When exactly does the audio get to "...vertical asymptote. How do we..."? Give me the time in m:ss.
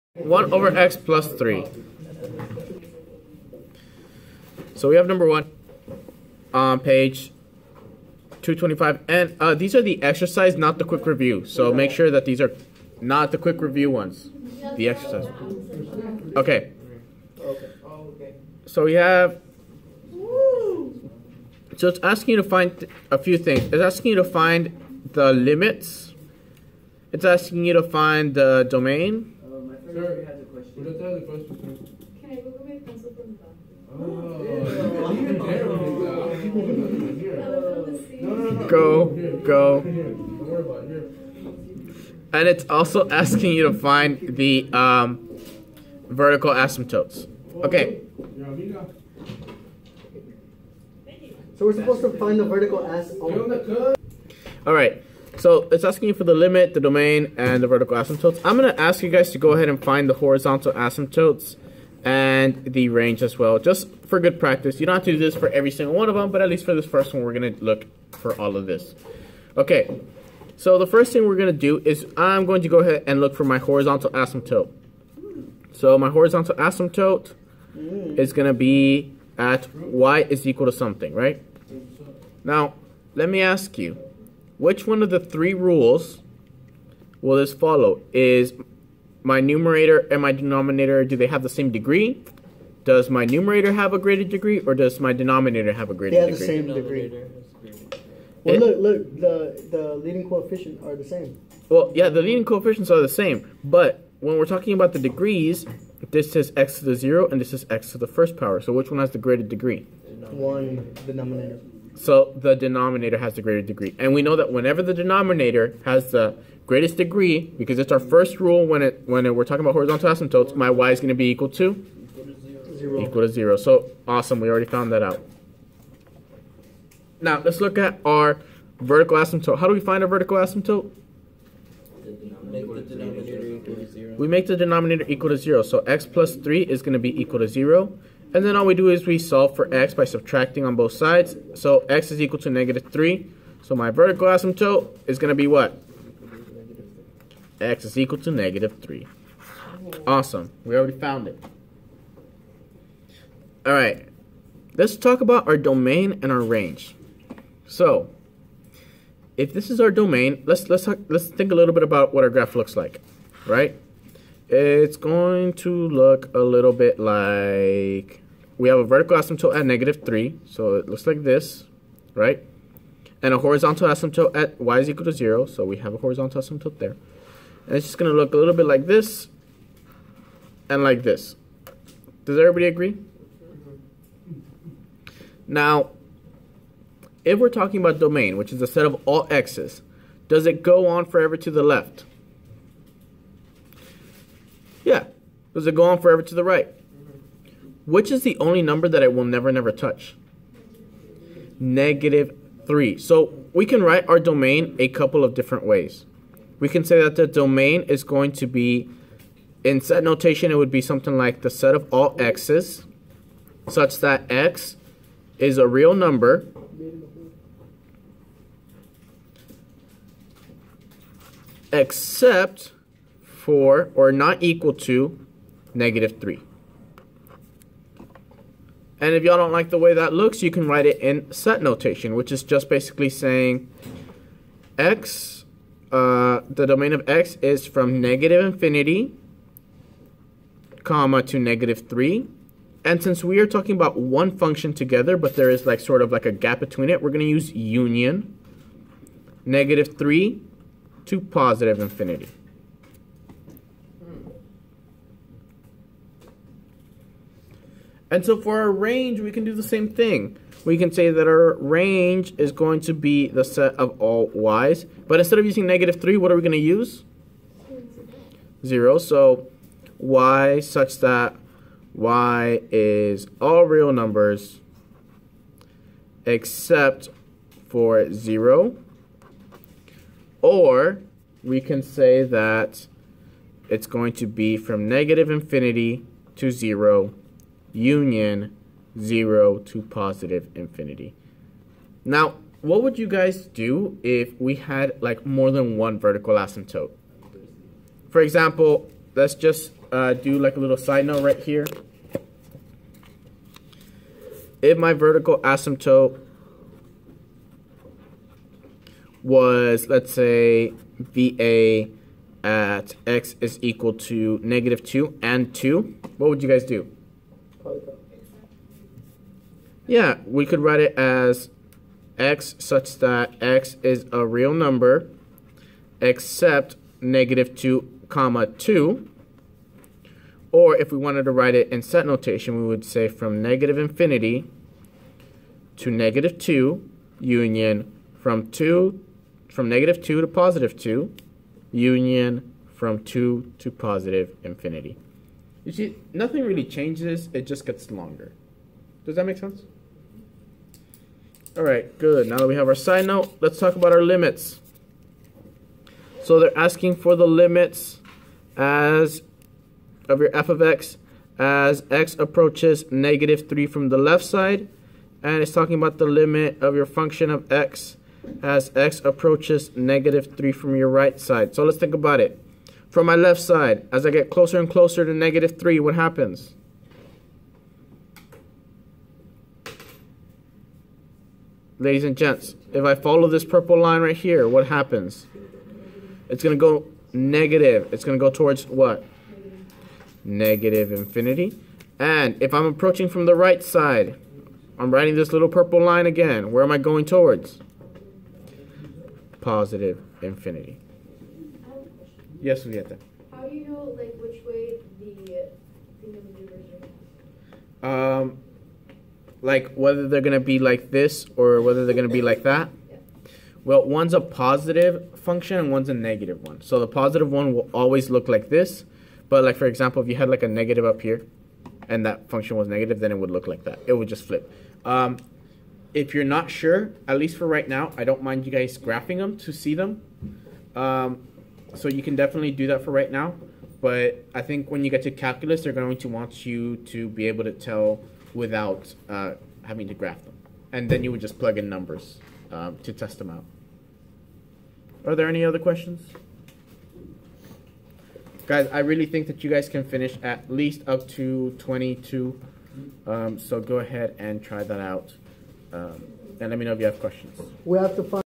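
2:08.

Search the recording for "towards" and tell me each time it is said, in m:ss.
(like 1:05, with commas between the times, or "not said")
6:28, 6:37.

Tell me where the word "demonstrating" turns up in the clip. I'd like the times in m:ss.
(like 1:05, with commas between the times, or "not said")
not said.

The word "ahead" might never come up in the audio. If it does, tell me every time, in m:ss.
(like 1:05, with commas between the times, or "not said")
0:59, 1:12, 7:33.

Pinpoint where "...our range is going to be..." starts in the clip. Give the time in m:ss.
4:21.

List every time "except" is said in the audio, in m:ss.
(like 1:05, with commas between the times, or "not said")
3:41, 4:36, 5:25.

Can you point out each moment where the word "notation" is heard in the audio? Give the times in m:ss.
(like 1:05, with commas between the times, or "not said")
3:30, 3:51, 5:32.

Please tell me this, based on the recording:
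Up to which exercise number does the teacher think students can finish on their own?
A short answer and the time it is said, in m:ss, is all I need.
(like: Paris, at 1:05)
22, at 7:31.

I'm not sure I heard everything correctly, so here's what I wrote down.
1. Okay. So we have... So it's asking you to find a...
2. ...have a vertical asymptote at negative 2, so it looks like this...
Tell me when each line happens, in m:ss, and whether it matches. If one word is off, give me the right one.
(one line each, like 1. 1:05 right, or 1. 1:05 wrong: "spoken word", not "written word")
1. 0:16 right
2. 2:48 wrong: "3", not "2".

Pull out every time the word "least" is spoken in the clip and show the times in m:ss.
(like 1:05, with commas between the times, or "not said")
1:06, 7:07, 7:30.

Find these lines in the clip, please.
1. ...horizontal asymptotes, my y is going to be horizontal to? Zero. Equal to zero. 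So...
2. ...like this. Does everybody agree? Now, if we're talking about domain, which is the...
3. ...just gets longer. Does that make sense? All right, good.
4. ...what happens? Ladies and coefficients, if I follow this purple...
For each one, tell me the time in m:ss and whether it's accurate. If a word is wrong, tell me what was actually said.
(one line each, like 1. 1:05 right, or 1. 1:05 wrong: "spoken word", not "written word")
1. 1:59 wrong: "equal", not "horizontal"
2. 3:00 right
3. 5:47 right
4. 6:15 wrong: "gents", not "coefficients".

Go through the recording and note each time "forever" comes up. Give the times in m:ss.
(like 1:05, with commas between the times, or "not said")
3:11, 3:15.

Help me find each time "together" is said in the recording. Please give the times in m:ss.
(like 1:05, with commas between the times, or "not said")
4:04.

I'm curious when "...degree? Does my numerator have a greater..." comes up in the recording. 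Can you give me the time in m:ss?
1:31.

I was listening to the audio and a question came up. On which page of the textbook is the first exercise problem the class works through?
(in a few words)
225.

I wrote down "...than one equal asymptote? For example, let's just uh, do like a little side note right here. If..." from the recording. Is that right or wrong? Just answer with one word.
wrong.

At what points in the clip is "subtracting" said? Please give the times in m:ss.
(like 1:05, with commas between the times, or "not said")
2:20.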